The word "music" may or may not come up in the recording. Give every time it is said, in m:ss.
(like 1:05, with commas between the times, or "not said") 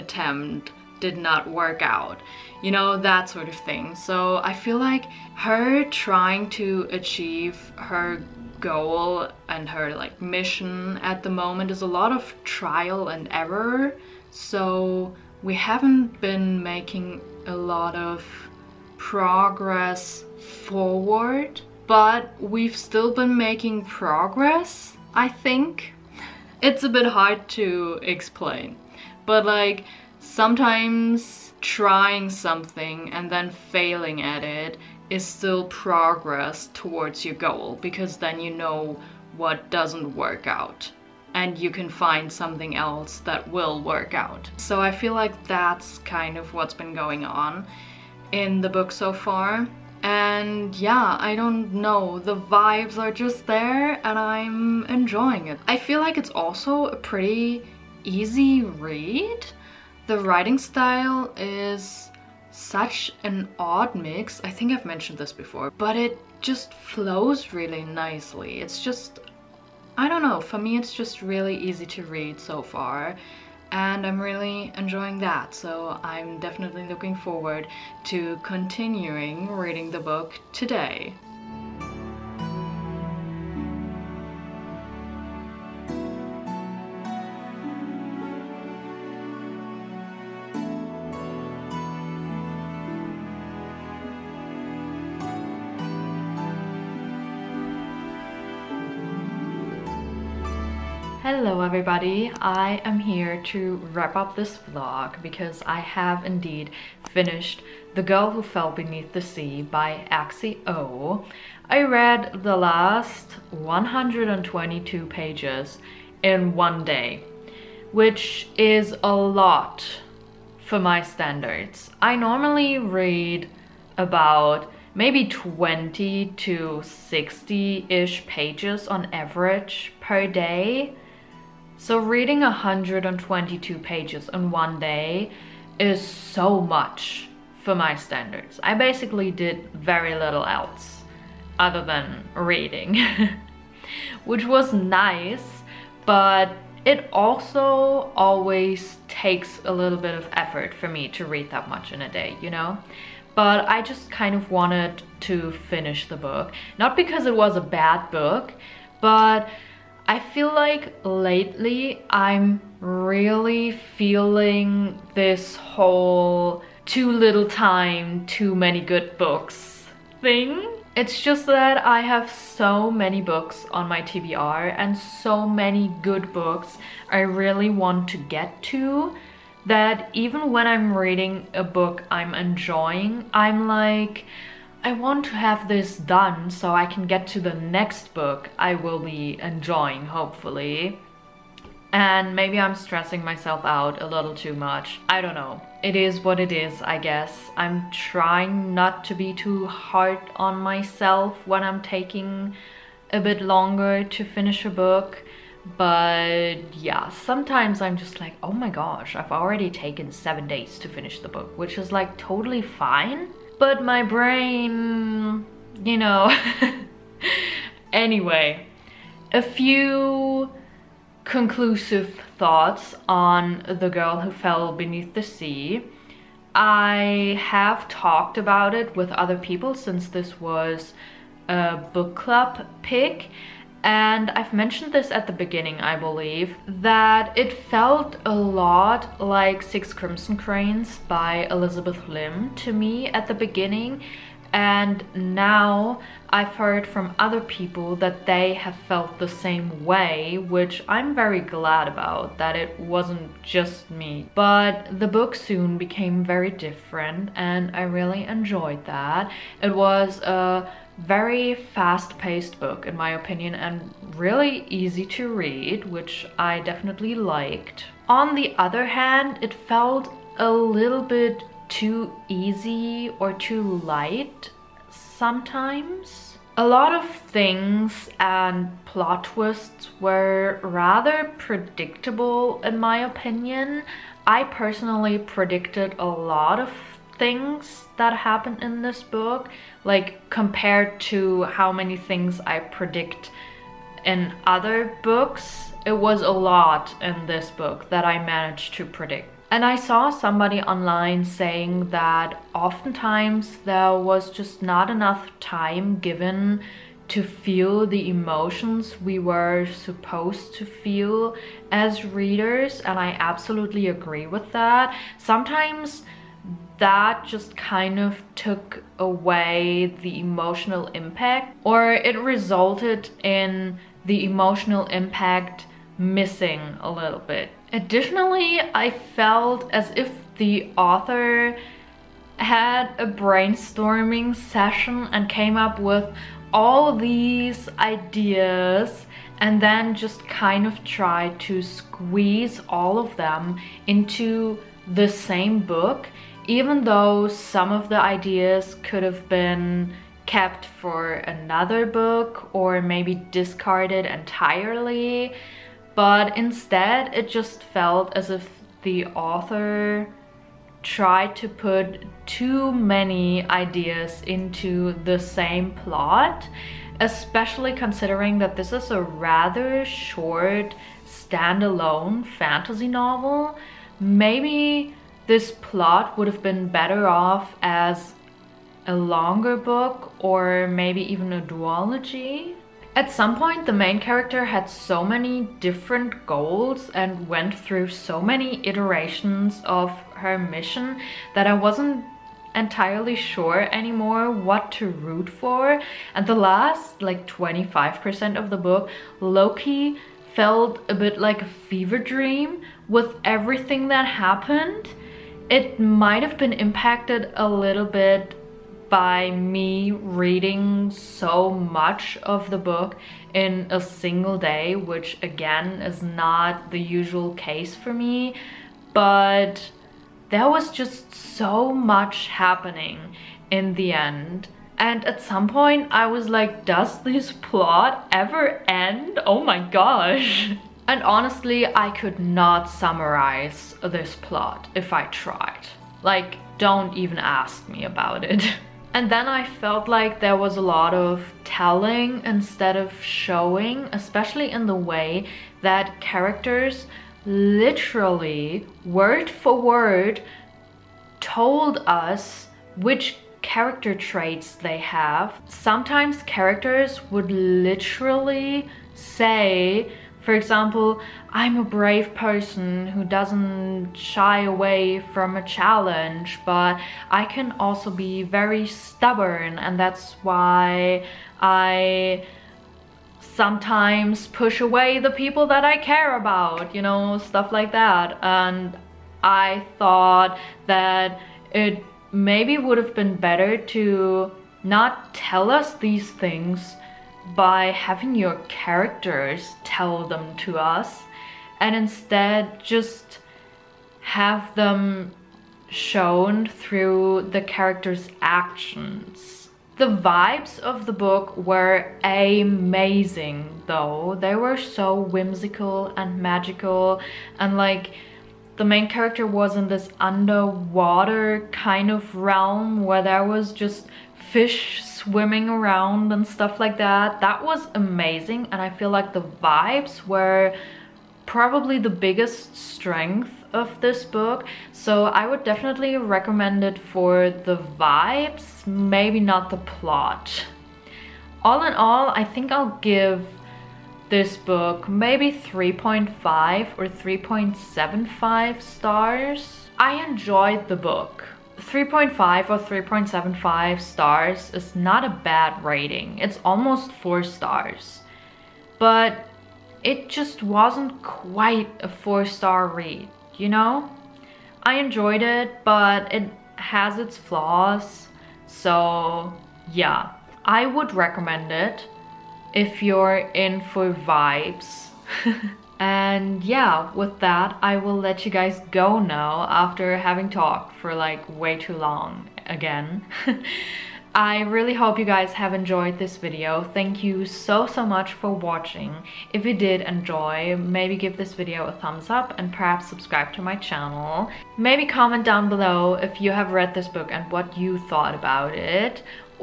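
not said.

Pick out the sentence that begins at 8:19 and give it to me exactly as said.
The vibes of the book were amazing though.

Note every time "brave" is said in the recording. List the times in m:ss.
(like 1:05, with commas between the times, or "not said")
7:41.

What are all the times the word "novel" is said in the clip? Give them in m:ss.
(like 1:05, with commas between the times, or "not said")
6:12.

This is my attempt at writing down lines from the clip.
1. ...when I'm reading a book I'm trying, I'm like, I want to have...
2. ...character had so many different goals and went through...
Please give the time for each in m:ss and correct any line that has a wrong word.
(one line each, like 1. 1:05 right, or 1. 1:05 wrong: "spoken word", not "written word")
1. 3:00 wrong: "enjoying", not "trying"
2. 6:24 right.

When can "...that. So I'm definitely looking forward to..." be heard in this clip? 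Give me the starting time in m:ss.
1:15.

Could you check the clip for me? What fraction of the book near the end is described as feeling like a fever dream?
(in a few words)
25%.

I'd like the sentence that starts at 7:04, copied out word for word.
And at some point I was like, does this plot ever end?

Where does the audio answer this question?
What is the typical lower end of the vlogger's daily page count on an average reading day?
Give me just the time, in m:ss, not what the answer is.
2:05.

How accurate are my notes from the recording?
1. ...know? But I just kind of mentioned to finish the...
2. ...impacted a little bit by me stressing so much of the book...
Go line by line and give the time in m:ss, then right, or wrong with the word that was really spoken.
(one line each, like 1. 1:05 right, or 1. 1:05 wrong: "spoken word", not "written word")
1. 2:32 wrong: "wanted", not "mentioned"
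2. 6:46 wrong: "reading", not "stressing".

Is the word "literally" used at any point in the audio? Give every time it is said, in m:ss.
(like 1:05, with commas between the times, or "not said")
7:27, 7:37.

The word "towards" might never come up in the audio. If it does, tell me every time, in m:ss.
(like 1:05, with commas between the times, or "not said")
0:36.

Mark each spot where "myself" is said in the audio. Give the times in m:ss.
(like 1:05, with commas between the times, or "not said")
3:13, 3:20.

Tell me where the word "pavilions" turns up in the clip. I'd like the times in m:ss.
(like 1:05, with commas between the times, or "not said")
not said.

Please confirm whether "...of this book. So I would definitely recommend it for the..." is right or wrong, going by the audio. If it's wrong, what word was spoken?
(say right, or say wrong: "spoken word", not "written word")
right.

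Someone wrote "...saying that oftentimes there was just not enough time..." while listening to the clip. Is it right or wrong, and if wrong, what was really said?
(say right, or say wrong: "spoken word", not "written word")
right.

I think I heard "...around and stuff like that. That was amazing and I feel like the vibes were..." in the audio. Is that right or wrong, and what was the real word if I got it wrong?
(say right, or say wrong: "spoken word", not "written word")
right.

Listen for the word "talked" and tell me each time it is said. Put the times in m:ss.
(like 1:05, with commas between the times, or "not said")
3:47, 9:30.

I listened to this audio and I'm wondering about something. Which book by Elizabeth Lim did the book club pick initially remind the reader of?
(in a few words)
Six Crimson Cranes.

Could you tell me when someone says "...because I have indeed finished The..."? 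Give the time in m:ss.
1:45.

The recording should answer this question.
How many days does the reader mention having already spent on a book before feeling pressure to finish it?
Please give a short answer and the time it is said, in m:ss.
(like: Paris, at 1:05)
7, at 3:30.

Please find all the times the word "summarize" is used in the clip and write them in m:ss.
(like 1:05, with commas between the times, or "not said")
7:12.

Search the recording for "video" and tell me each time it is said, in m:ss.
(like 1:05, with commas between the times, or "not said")
9:36, 9:41.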